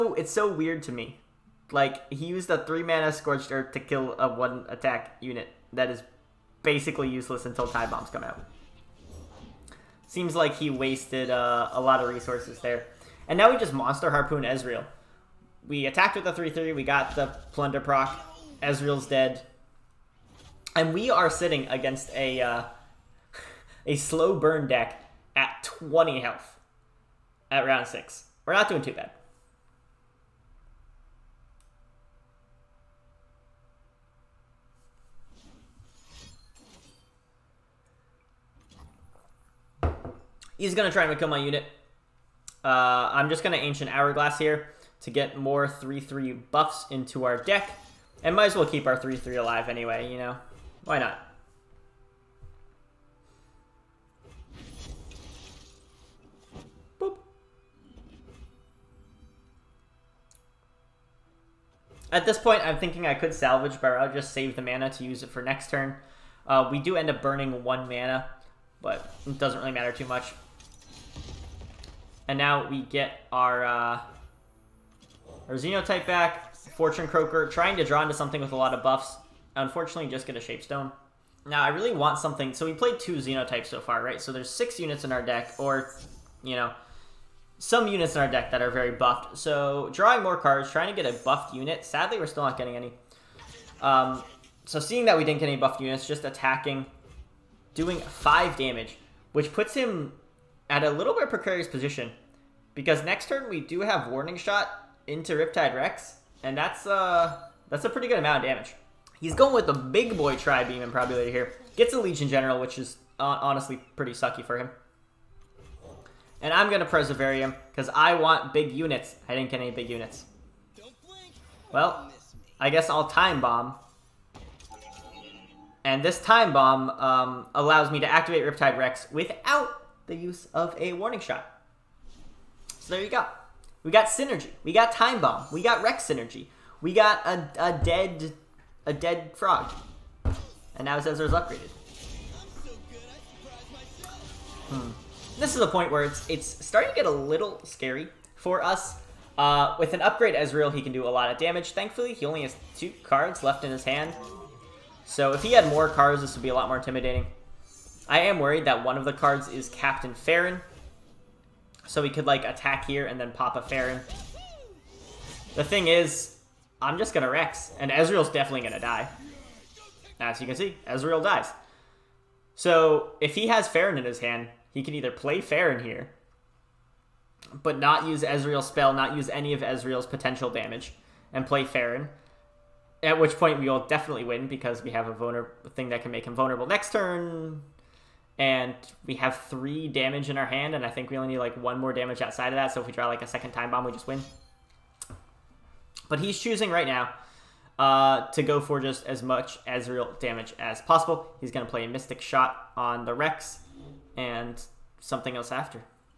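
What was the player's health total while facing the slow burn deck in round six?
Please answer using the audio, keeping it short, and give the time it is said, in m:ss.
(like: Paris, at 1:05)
20, at 0:25.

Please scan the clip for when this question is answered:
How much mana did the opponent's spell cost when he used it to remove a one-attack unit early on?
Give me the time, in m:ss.
0:02.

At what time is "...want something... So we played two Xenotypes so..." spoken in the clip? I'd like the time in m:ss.
1:21.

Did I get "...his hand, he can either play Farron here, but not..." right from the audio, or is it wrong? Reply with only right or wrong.
right.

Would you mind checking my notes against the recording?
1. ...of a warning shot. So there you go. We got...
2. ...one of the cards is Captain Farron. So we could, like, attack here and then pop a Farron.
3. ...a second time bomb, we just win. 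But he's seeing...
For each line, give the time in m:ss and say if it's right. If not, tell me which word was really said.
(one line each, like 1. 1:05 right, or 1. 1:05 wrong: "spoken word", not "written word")
1. 2:10 right
2. 2:38 right
3. 3:13 wrong: "choosing", not "seeing".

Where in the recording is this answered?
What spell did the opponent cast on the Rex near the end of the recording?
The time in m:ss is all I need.
3:21.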